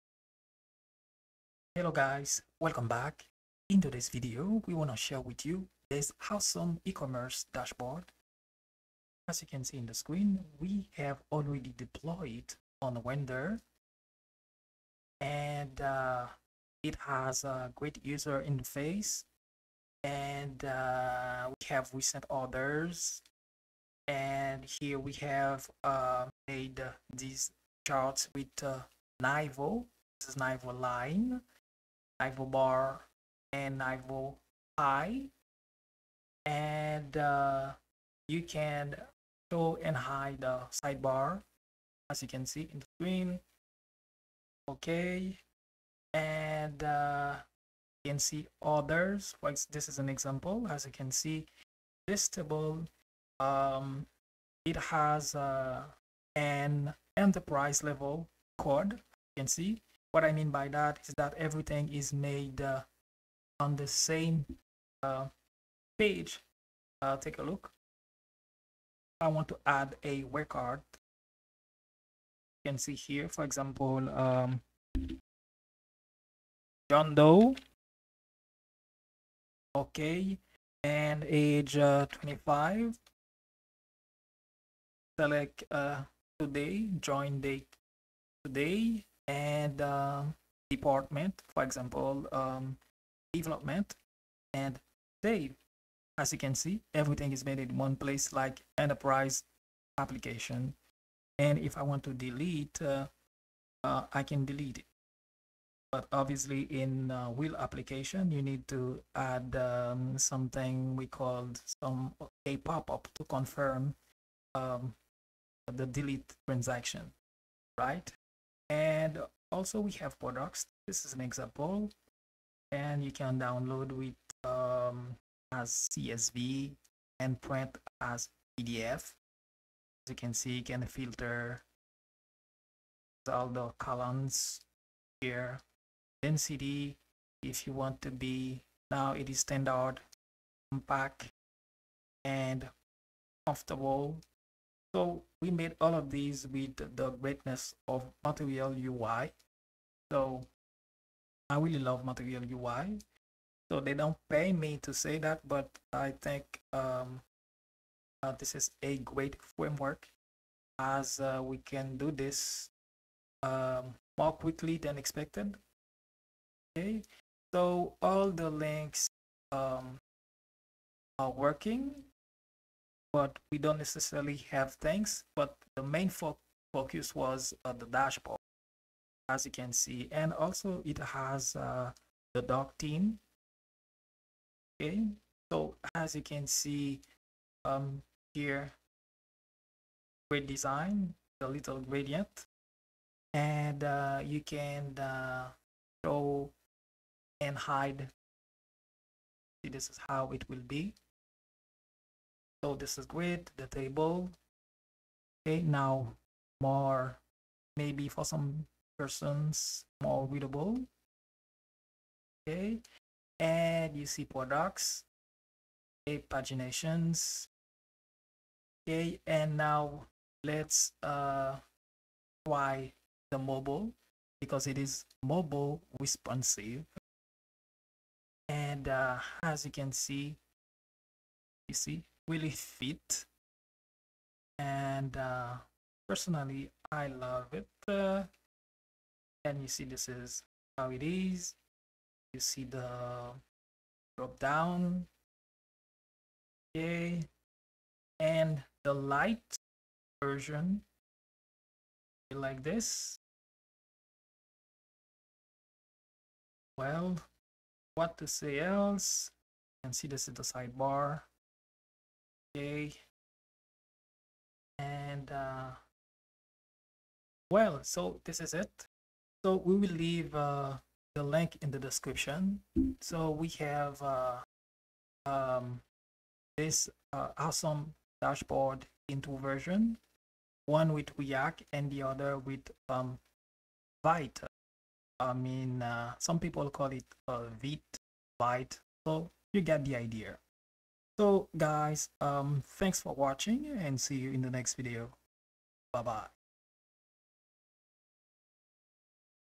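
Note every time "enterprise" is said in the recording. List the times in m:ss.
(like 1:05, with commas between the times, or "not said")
0:57, 1:38.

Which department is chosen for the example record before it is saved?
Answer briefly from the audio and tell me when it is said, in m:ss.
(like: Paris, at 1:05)
Development, at 1:33.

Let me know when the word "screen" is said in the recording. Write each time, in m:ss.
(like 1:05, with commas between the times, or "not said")
0:09, 0:42.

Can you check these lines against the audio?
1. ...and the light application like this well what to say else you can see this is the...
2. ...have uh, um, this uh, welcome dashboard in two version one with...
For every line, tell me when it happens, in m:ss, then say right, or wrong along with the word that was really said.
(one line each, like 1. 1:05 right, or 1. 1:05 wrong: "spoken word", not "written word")
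1. 4:08 wrong: "version", not "application"
2. 4:33 wrong: "awesome", not "welcome".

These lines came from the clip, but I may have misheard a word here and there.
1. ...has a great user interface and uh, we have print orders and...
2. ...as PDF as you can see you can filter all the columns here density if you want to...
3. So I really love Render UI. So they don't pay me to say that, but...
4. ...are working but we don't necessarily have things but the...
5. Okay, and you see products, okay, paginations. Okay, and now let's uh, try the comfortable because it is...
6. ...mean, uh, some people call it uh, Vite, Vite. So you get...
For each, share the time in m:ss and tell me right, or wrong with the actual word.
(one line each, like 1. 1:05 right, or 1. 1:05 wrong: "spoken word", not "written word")
1. 0:17 wrong: "recent", not "print"
2. 2:07 right
3. 2:30 wrong: "Material", not "Render"
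4. 2:51 right
5. 3:32 wrong: "mobile", not "comfortable"
6. 4:45 right.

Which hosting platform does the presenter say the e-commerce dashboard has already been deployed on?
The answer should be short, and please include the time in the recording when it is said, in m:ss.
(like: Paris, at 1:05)
Render, at 0:13.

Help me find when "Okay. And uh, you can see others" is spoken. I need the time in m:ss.
0:44.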